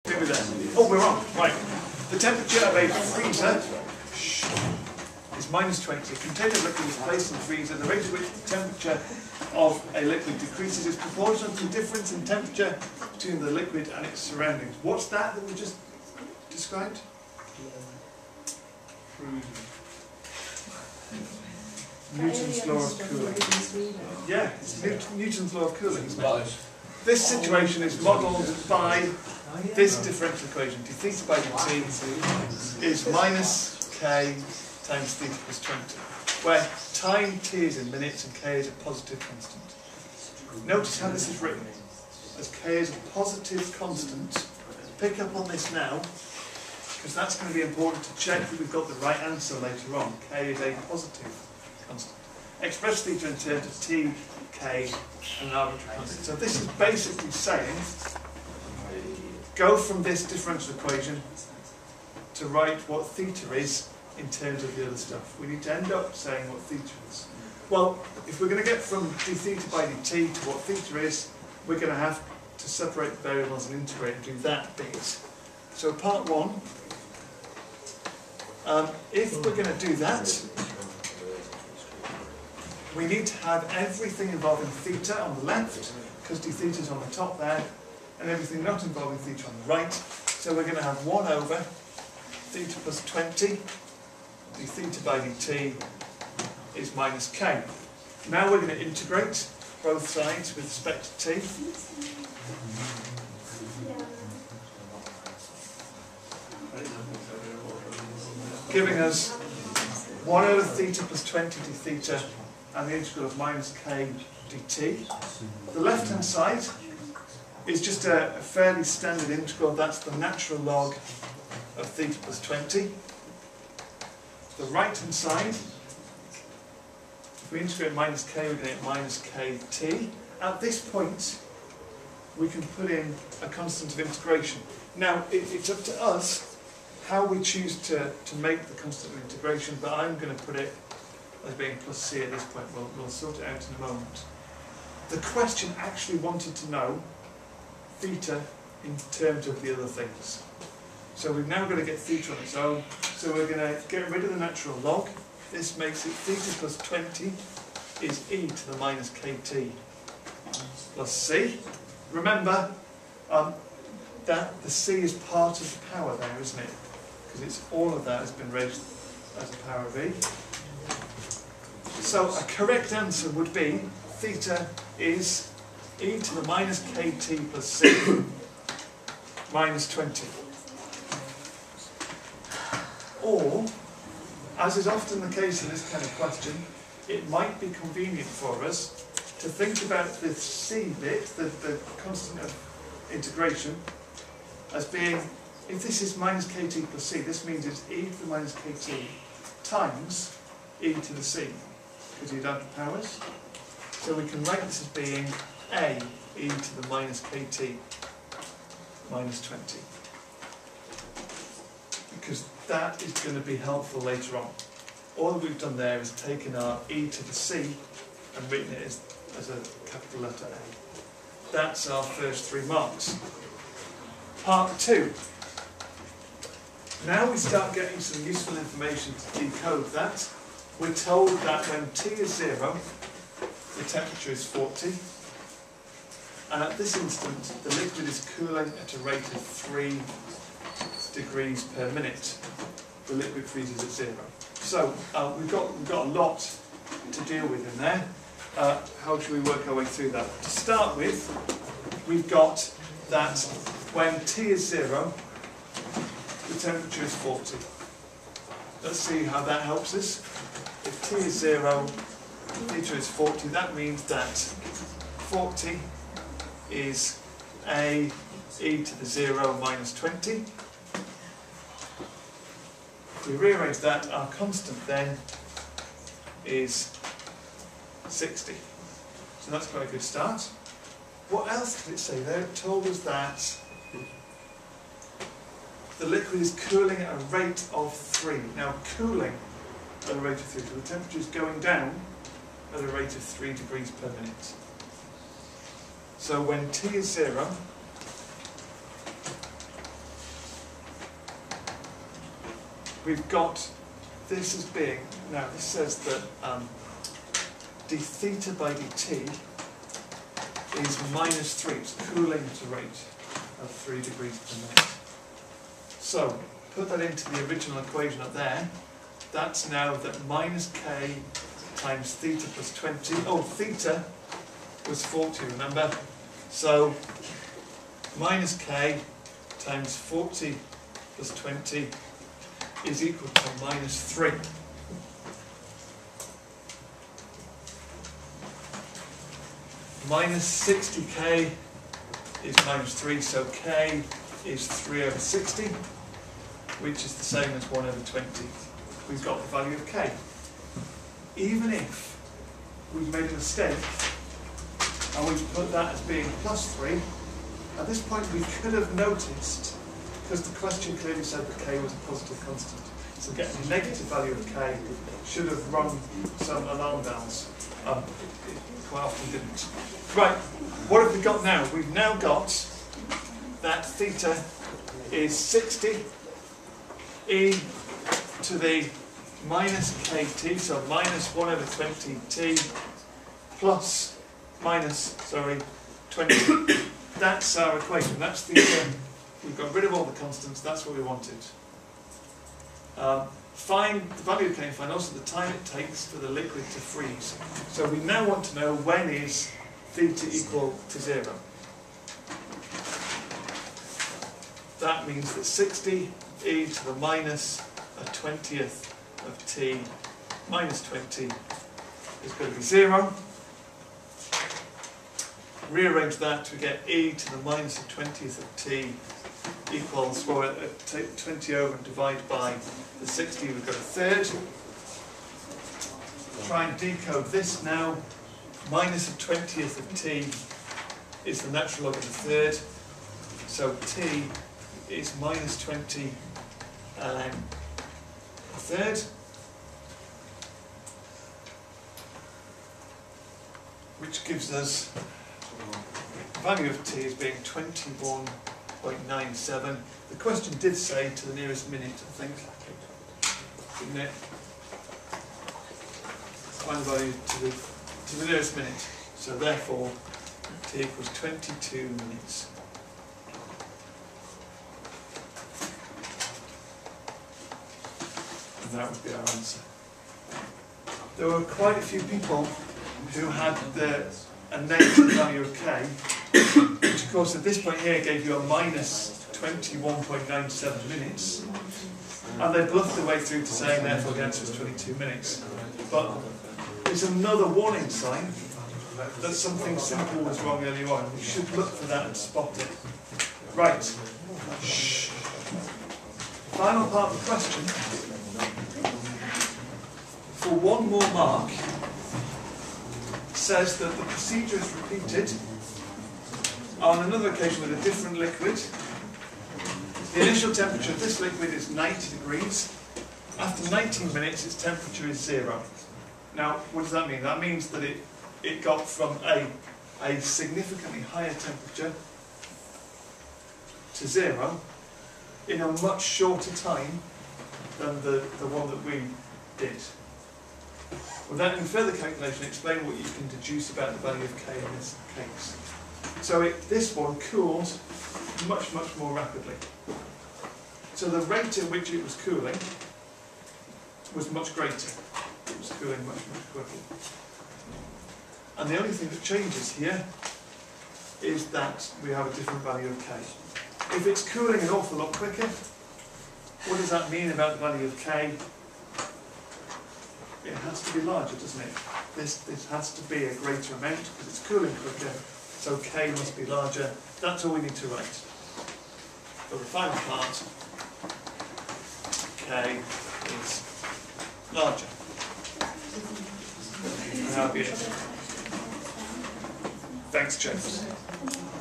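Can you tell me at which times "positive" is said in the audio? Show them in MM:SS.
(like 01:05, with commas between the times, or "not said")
00:38, 00:43, 00:50, 06:02.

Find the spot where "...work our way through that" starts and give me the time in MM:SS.
04:09.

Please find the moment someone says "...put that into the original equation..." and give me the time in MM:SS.
05:16.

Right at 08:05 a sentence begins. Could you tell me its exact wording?
But it's another warning sign that something simple was wrong earlier on.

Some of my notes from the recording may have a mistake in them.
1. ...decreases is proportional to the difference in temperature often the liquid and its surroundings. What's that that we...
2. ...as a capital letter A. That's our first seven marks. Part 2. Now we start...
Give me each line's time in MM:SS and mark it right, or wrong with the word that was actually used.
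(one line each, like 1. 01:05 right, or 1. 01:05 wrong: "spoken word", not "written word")
1. 00:10 wrong: "between", not "often"
2. 03:39 wrong: "three", not "seven".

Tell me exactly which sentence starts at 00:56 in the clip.
So this is basically saying go from this differential equation to write what theta is in terms of the other stuff.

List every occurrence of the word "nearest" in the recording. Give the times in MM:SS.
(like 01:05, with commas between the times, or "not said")
07:31, 07:38.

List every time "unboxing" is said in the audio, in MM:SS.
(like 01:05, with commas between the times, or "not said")
not said.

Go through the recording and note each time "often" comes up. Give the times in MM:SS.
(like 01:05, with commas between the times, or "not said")
03:04, 06:09.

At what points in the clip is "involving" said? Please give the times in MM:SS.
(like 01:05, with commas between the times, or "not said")
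01:24, 01:28.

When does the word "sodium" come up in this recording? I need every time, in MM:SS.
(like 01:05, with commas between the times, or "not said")
not said.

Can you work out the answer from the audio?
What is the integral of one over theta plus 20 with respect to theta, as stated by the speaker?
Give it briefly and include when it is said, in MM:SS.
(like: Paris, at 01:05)
natural log of theta plus 20, at 02:00.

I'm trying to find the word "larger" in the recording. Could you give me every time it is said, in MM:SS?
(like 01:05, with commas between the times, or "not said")
09:21, 09:26, 09:34.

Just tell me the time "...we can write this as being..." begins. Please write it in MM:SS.
03:24.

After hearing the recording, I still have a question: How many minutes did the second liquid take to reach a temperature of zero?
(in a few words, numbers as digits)
19.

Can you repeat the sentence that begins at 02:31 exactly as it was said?
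So we've now got to get theta on its own.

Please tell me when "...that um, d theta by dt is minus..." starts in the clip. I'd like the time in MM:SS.
05:06.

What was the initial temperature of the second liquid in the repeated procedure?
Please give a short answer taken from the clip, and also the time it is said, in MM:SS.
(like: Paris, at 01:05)
90 degrees, at 08:31.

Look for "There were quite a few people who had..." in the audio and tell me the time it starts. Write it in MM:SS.
07:51.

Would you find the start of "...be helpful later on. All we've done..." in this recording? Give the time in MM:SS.
03:33.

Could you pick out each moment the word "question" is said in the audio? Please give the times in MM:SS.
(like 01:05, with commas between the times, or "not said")
02:25, 03:06, 06:00, 07:30, 08:17.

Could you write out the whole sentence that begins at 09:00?
So the rate at which it was cooling was much greater.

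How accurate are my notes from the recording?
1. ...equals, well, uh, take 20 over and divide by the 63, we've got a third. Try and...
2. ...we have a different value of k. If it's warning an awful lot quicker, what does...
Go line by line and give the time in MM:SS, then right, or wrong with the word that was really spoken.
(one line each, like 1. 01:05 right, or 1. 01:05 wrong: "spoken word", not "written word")
1. 06:59 wrong: "60", not "63"
2. 09:12 wrong: "cooling", not "warning".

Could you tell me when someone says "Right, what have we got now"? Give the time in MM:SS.
06:10.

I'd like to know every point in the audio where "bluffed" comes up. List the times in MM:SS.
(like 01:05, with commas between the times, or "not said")
08:02.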